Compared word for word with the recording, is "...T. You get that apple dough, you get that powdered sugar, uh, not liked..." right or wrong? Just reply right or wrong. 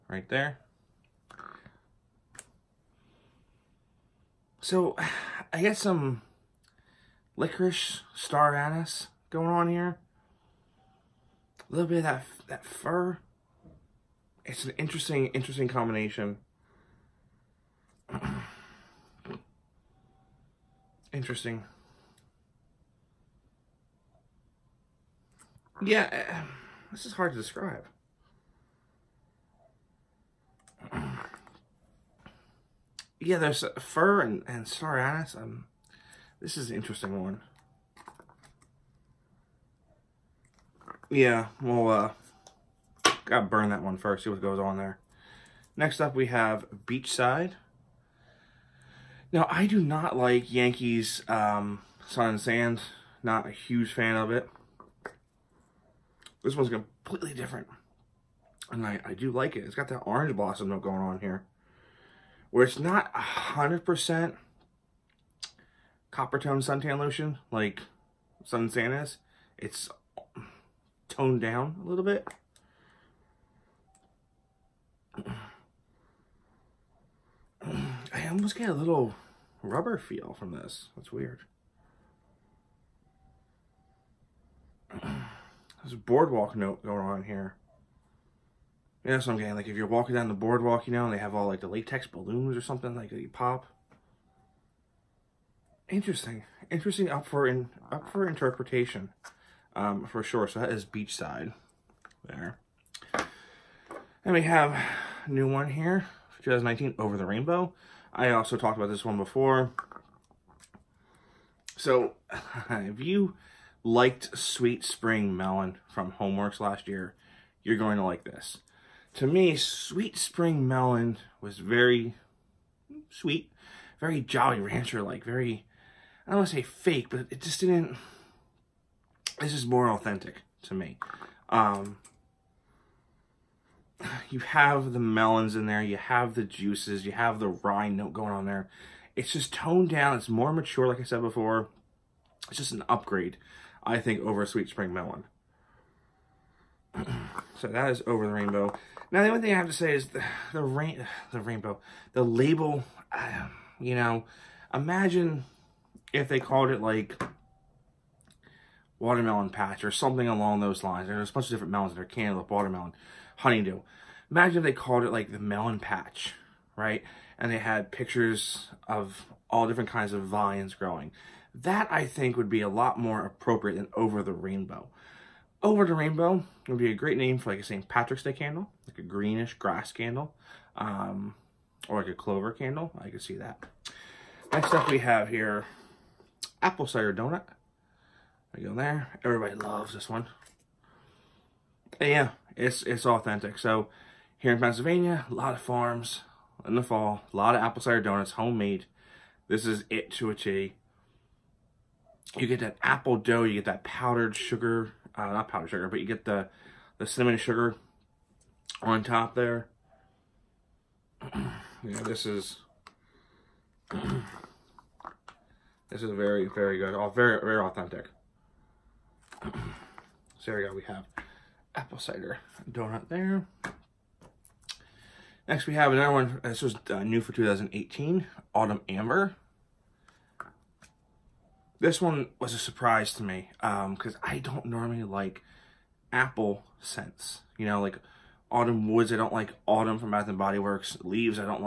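wrong.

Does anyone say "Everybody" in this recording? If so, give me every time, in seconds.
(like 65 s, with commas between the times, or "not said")
189 s.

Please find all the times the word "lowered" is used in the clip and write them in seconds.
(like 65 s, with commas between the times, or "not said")
not said.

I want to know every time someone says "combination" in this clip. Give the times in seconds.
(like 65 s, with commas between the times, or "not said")
15 s.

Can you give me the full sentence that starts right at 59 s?
It's got that orange blossom note going on here.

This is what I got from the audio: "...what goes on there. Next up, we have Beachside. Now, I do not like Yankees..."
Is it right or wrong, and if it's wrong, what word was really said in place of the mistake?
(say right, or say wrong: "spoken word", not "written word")
right.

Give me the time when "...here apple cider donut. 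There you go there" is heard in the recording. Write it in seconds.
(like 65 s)
185 s.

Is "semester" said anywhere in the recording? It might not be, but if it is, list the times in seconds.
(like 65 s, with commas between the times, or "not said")
not said.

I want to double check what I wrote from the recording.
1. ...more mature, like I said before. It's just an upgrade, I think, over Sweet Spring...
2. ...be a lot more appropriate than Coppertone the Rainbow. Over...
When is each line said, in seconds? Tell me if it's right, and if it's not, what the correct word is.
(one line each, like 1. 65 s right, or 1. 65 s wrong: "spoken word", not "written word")
1. 140 s right
2. 172 s wrong: "Over", not "Coppertone".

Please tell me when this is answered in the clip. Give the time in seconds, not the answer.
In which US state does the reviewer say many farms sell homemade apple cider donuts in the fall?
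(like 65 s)
194 s.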